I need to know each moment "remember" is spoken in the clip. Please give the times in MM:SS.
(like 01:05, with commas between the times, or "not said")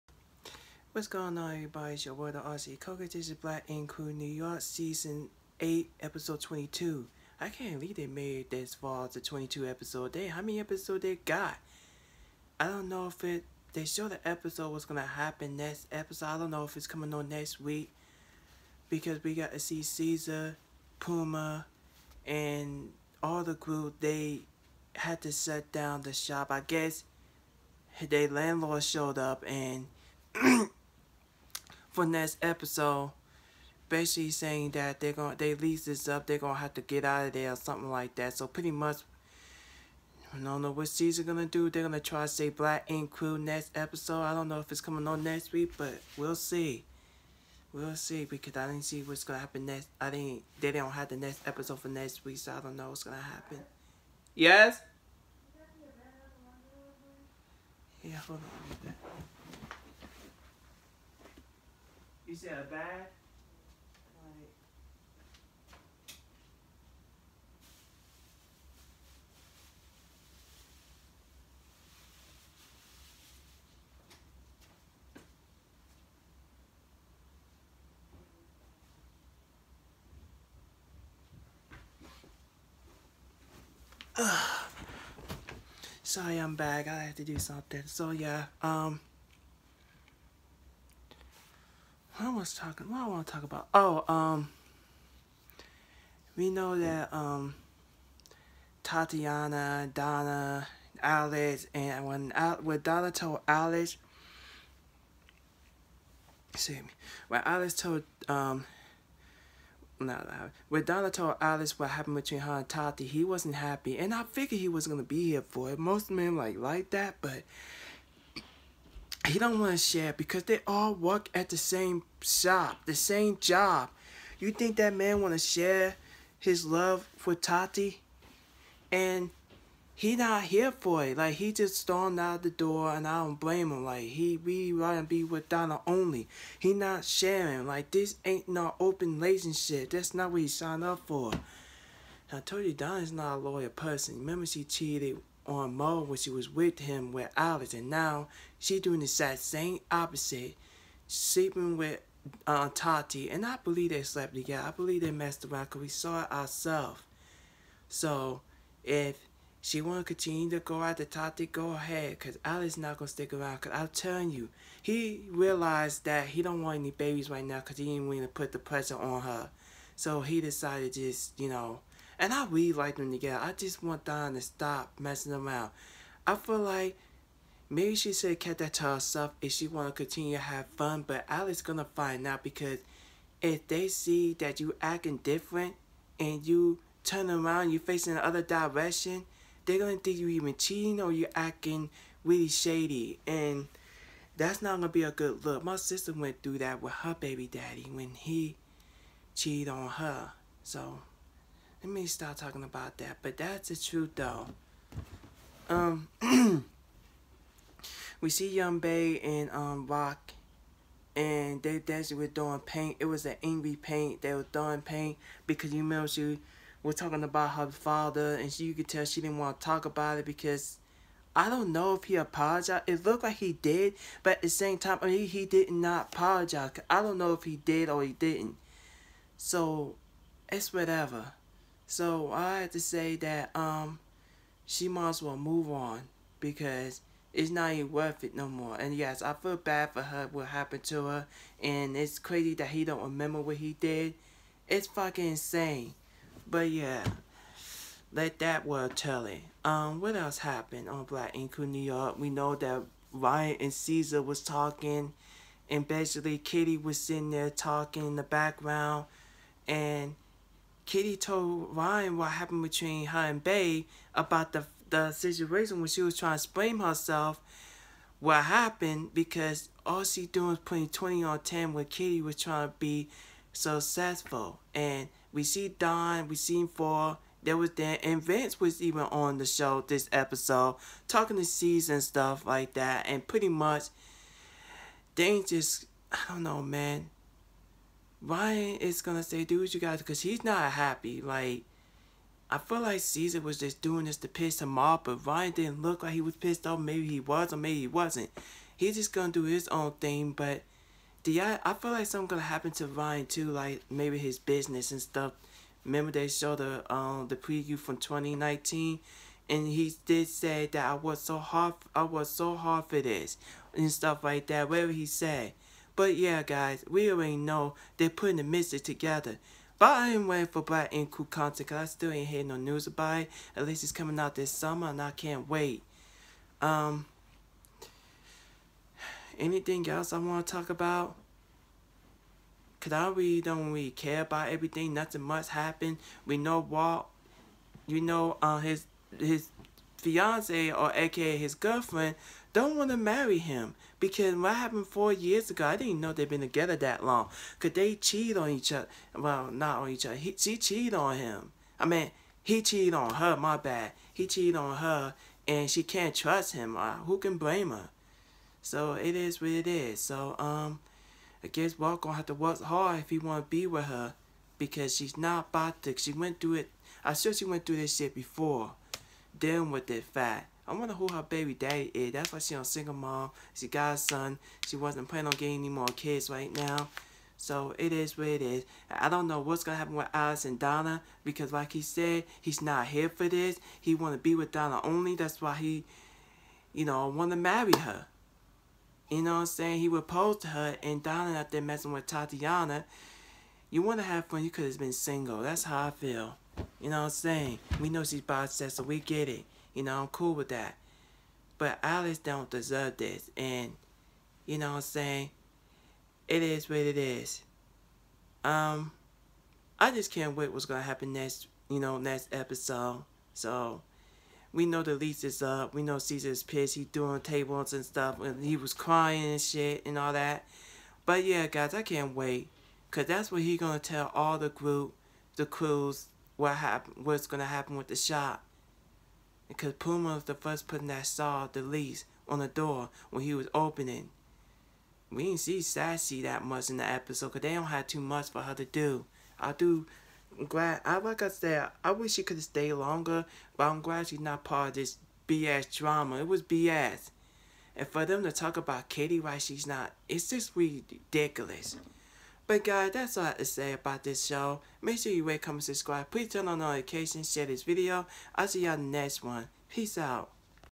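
02:24, 03:35, 04:03, 05:05.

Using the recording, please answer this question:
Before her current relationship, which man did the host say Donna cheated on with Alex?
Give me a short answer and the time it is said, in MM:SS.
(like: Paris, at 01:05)
Mo, at 02:25.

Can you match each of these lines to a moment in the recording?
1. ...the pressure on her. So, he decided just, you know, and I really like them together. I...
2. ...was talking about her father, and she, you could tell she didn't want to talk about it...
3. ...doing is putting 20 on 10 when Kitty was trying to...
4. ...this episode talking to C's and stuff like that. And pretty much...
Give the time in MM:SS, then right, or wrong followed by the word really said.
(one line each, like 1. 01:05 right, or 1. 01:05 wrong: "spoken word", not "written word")
1. 02:48 right
2. 03:36 right
3. 04:30 right
4. 04:39 right.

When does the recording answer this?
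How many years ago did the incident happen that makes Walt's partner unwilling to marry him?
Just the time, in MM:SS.
05:44.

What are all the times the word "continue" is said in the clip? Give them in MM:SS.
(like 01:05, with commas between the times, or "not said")
02:40, 02:59.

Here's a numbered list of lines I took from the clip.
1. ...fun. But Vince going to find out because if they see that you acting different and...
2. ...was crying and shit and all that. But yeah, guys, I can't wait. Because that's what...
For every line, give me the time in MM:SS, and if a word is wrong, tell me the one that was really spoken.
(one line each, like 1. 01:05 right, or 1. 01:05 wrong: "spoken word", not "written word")
1. 03:00 wrong: "Alex", not "Vince"
2. 06:58 right.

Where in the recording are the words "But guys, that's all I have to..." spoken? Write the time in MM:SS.
07:32.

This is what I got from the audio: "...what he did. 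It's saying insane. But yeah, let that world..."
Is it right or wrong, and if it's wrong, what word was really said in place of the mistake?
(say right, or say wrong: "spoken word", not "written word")
wrong: "fucking", not "saying".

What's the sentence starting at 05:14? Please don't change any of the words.
Whatever he said but yeah, guys, we already know they're putting the music together.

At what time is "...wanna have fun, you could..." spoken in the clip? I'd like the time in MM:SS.
06:33.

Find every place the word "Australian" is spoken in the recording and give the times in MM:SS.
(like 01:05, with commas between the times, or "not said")
not said.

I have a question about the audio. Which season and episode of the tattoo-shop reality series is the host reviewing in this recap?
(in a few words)
Season 8, Episode 22.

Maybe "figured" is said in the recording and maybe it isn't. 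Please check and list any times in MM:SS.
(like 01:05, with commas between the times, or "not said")
01:54.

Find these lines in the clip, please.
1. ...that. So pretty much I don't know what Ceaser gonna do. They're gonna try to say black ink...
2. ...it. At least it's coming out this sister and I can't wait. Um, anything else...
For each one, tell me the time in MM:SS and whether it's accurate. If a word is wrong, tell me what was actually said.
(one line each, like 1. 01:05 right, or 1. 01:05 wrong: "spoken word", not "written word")
1. 00:38 right
2. 05:23 wrong: "summer", not "sister".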